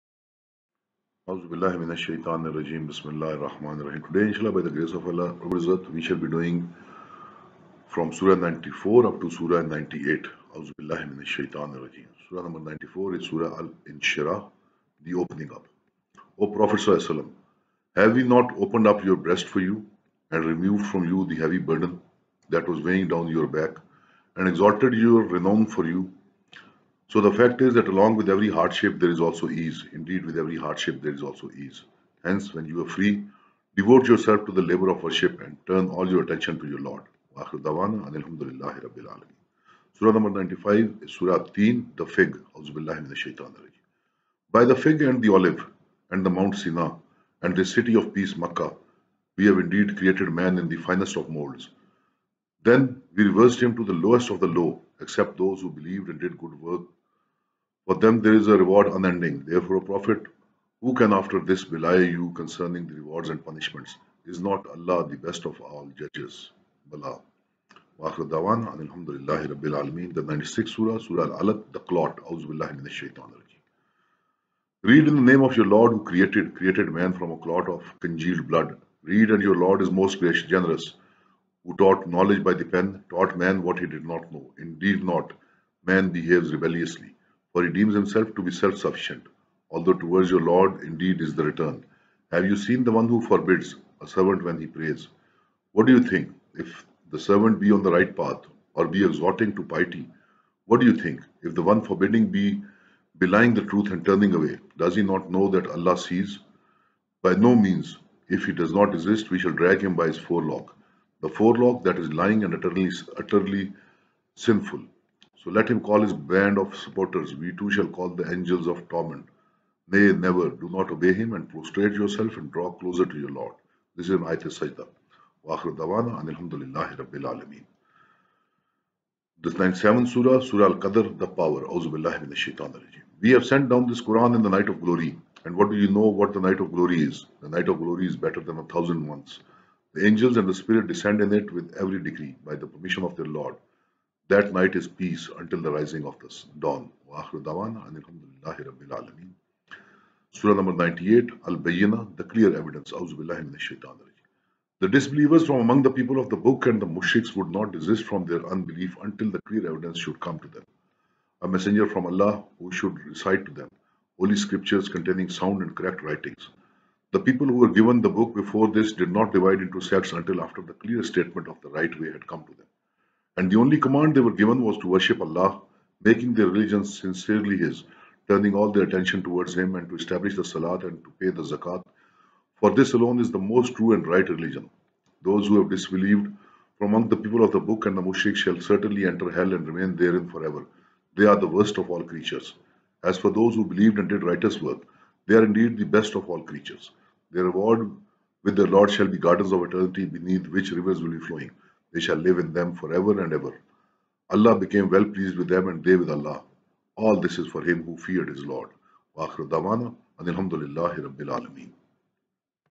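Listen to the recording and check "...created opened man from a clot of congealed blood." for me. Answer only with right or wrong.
wrong.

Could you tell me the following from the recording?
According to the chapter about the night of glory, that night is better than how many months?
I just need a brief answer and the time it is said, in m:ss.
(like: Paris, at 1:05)
1000, at 2:18.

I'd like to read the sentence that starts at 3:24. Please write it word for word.
Allah became well pleased with them and they with Allah.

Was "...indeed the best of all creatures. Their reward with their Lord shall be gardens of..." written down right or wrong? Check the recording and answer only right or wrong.
right.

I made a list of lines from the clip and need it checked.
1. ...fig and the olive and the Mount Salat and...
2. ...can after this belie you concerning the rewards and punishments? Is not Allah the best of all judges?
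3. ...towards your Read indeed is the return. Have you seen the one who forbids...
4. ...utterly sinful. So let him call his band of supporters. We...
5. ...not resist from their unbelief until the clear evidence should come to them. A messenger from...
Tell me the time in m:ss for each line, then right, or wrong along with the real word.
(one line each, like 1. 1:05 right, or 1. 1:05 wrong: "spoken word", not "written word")
1. 0:44 wrong: "Sina", not "Salat"
2. 1:00 right
3. 1:29 wrong: "Lord", not "Read"
4. 1:53 right
5. 2:37 wrong: "desist", not "resist".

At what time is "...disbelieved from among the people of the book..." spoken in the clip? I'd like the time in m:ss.
3:05.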